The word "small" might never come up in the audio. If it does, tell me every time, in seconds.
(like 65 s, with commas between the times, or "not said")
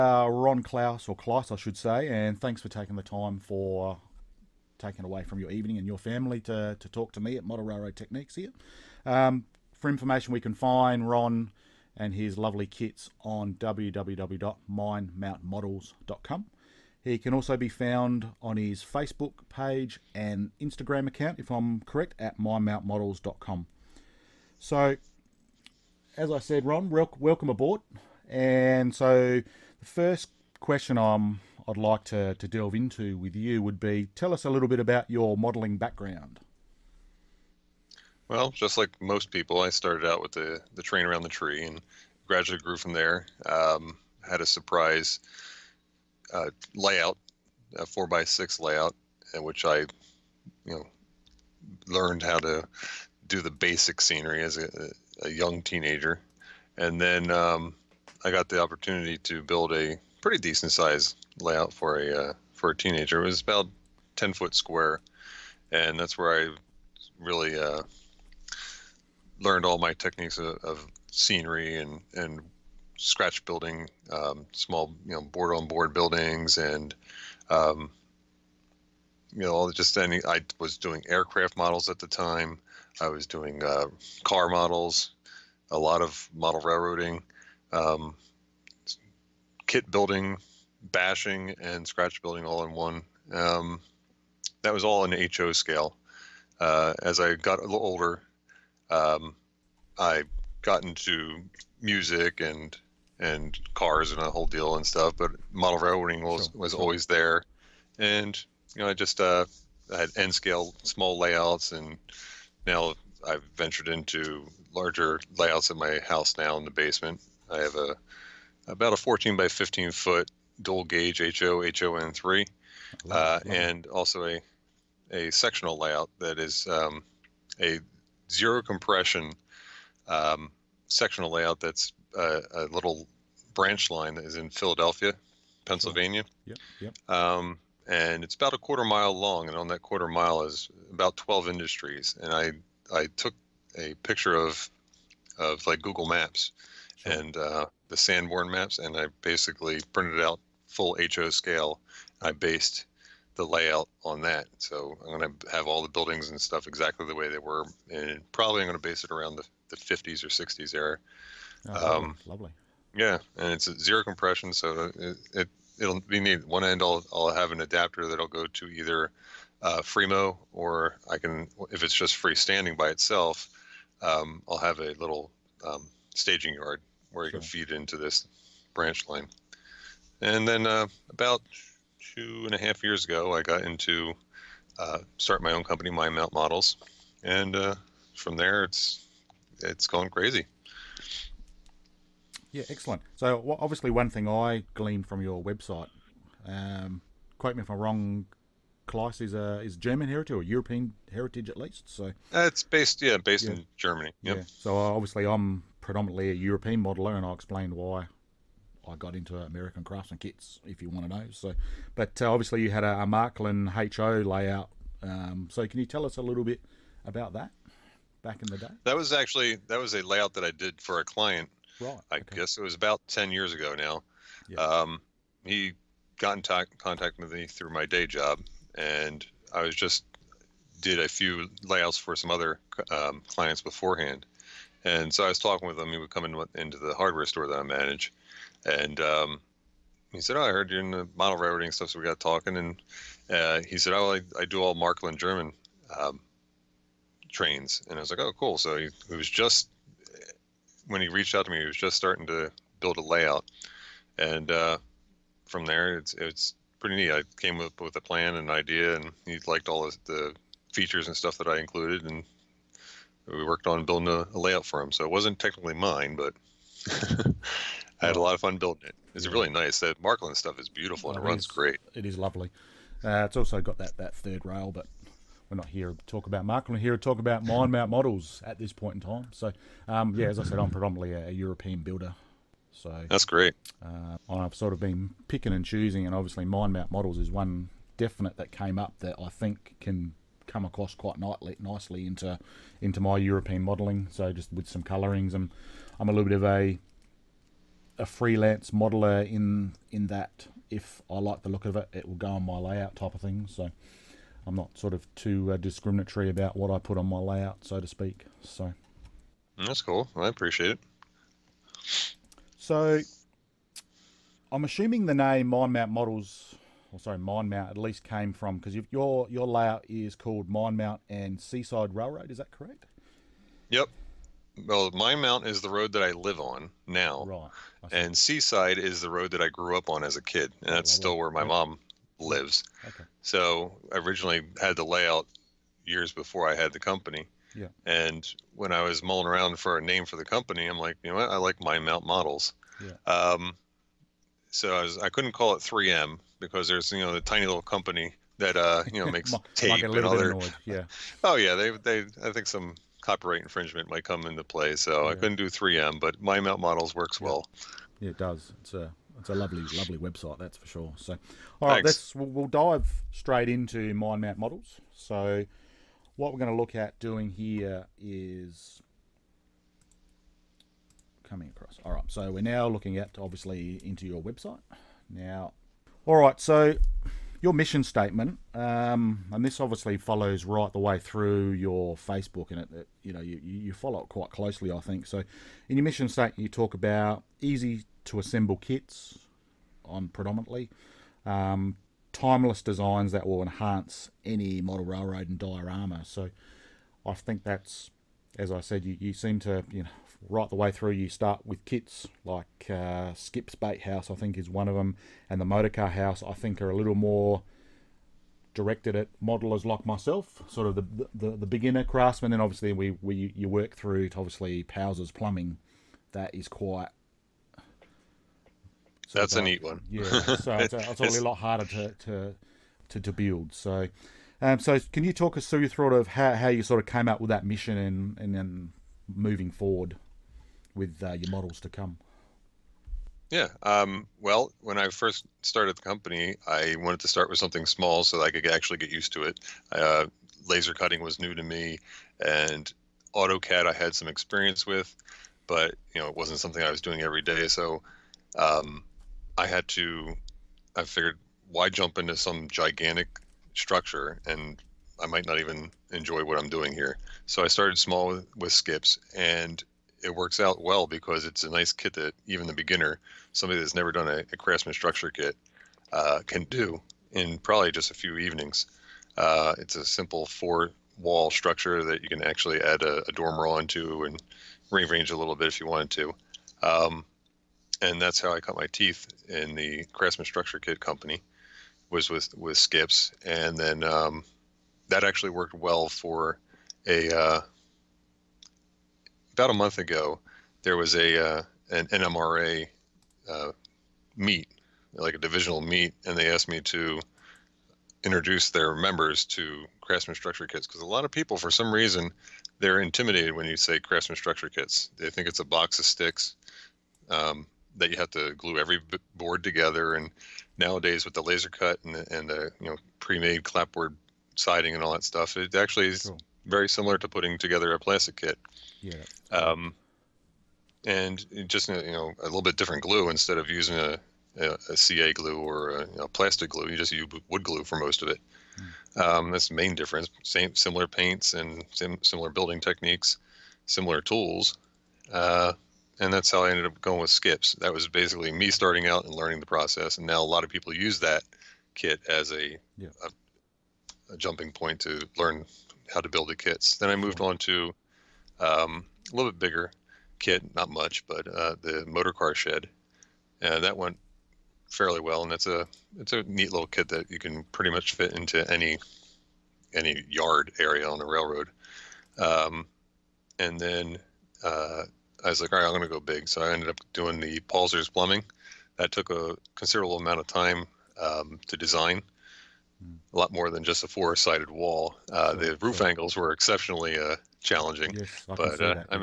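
74 s, 110 s, 437 s, 457 s.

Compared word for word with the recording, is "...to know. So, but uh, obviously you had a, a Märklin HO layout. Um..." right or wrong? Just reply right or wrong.
right.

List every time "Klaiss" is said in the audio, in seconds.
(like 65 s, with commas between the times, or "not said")
1 s, 198 s.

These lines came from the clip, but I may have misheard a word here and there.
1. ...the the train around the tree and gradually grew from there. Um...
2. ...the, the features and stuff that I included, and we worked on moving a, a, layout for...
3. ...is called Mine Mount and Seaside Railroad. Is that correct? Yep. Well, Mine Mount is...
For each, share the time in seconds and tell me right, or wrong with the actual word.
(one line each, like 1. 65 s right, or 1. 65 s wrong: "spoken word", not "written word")
1. 40 s right
2. 259 s wrong: "building", not "moving"
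3. 319 s right.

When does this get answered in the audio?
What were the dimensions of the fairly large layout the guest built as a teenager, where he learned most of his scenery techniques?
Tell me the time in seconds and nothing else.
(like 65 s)
64 s.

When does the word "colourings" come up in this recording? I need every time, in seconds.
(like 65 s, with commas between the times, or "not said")
294 s.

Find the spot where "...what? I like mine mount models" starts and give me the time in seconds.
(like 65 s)
341 s.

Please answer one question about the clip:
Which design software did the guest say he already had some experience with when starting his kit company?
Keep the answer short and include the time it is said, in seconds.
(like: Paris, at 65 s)
AutoCAD, at 443 s.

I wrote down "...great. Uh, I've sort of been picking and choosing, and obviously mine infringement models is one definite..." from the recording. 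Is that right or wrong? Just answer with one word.
wrong.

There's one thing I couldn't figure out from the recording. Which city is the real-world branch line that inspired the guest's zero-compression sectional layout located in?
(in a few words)
Philadelphia.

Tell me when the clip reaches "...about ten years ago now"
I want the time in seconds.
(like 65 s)
222 s.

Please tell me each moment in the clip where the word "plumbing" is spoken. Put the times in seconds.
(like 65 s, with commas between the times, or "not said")
415 s, 567 s.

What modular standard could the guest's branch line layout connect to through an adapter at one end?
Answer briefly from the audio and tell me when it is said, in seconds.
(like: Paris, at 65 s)
Fremo, at 169 s.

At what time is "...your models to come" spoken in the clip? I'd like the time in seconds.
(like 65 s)
431 s.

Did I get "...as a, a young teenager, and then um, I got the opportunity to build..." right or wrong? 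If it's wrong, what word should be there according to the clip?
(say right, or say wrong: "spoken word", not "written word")
right.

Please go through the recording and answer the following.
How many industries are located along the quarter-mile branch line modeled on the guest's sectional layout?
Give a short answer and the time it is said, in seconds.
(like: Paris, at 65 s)
12, at 141 s.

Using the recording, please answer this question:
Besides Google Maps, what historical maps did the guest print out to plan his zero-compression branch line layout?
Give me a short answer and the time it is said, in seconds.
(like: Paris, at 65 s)
Sanborn maps, at 147 s.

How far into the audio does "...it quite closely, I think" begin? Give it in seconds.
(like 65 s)
384 s.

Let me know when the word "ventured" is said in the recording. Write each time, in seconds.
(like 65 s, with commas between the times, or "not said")
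113 s.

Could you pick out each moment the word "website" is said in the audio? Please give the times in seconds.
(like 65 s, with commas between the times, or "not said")
195 s, 359 s, 374 s.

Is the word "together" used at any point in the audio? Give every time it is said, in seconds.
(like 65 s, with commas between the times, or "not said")
509 s, 517 s.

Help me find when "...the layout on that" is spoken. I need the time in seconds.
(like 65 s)
153 s.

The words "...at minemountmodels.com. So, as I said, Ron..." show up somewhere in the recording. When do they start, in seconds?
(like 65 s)
22 s.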